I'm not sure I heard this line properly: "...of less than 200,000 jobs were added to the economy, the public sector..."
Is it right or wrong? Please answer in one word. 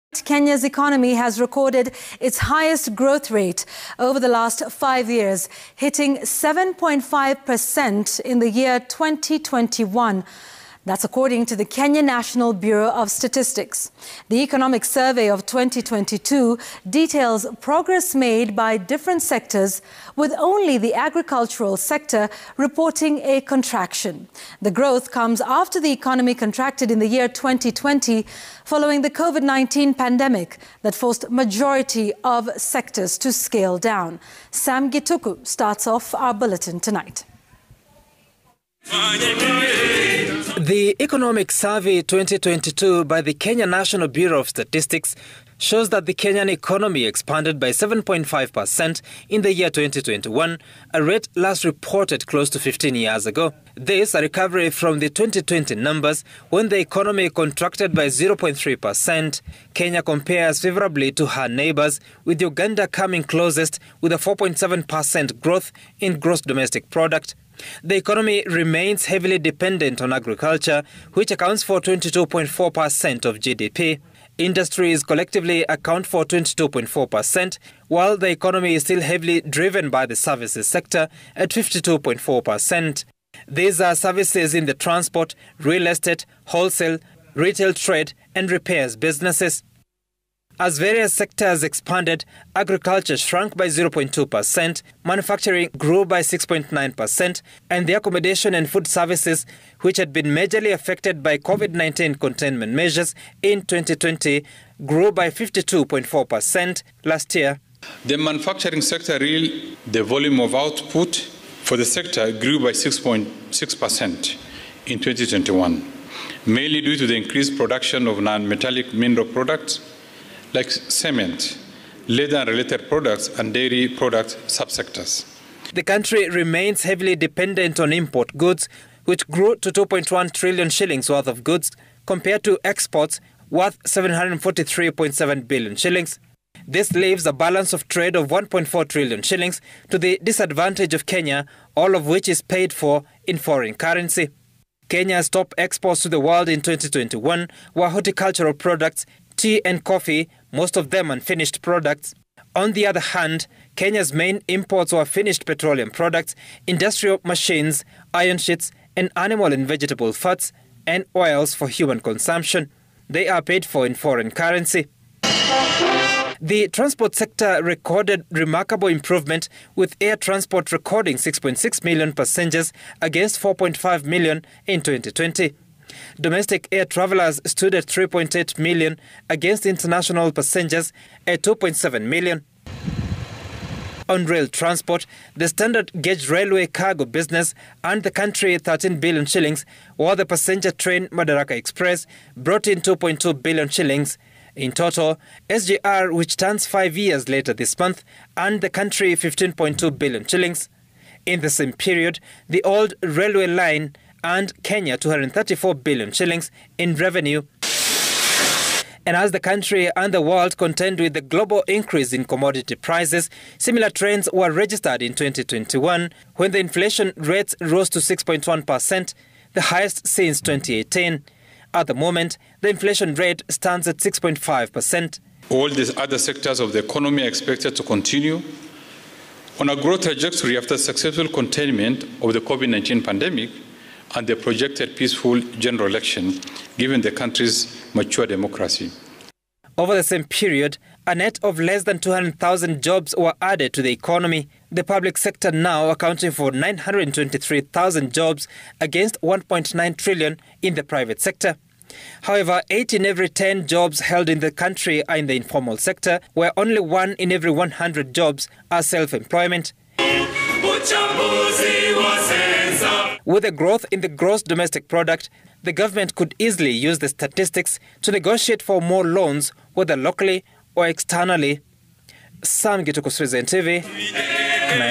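right.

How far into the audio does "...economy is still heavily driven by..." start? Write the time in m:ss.
1:18.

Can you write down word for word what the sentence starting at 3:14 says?
In total, SGR, which turns five years later this month, earned the country 15.2 billion shillings.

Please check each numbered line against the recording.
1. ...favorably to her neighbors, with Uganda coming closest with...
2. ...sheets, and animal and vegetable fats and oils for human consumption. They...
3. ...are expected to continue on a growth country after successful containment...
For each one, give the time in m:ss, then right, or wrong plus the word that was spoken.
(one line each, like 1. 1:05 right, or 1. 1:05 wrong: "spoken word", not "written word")
1. 1:00 right
2. 2:38 right
3. 3:47 wrong: "trajectory", not "country".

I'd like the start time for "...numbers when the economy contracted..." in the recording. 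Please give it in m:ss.
0:55.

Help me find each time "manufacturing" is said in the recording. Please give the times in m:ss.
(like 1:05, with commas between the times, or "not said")
1:35, 1:48.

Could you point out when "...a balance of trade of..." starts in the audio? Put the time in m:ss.
2:17.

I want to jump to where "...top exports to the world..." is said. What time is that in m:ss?
2:25.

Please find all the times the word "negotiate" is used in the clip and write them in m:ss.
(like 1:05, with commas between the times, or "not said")
4:28.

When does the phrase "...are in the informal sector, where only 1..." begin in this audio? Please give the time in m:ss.
4:15.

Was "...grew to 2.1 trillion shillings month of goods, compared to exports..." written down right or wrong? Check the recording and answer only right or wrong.
wrong.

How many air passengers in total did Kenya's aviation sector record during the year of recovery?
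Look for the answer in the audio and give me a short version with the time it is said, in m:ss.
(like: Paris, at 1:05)
6.6 million, at 2:51.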